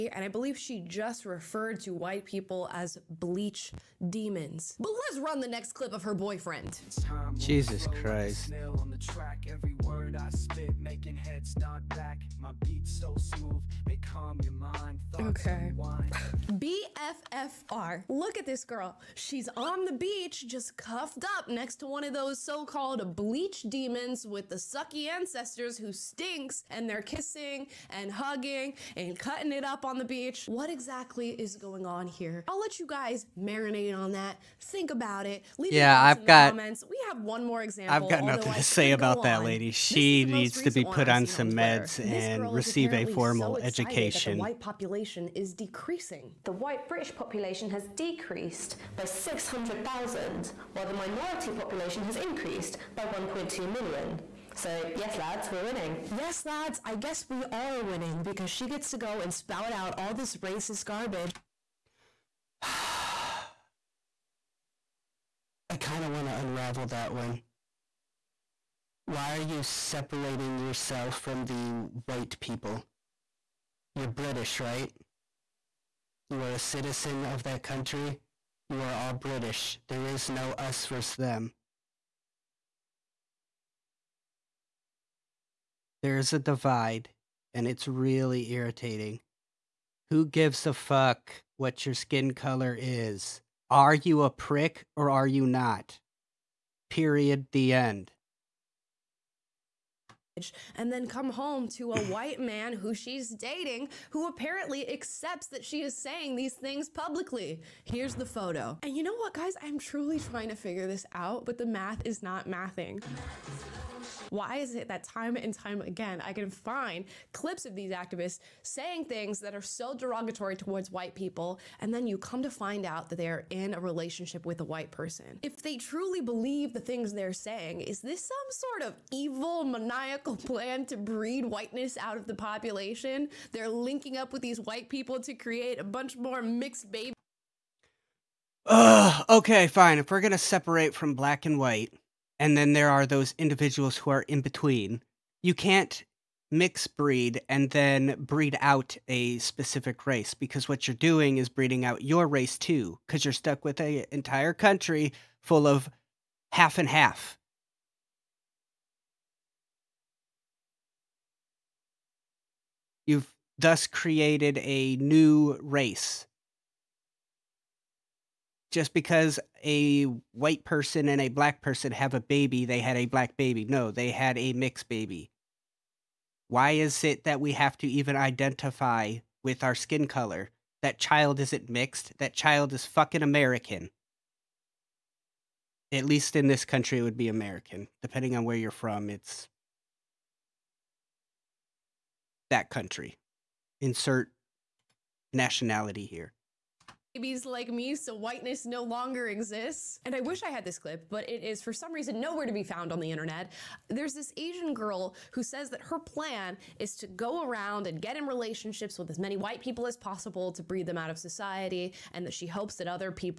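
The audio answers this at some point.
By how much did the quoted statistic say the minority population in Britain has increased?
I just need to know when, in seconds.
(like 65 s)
53 s.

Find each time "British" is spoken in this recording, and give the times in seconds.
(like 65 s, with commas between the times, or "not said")
46 s, 74 s, 79 s.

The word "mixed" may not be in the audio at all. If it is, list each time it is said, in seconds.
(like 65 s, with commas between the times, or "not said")
136 s, 174 s, 181 s.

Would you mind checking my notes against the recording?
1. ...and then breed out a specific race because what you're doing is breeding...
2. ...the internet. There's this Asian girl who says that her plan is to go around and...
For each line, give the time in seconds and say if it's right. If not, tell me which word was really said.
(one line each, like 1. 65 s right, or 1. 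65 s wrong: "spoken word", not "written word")
1. 147 s right
2. 202 s right.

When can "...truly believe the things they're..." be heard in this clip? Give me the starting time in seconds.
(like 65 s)
125 s.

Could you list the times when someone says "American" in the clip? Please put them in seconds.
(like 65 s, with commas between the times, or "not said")
183 s, 187 s.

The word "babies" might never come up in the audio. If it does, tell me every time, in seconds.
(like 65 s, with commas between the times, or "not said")
136 s, 197 s.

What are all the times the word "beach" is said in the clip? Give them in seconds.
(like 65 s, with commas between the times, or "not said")
19 s, 30 s.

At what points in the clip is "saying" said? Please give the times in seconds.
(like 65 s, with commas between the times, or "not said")
105 s, 118 s, 127 s.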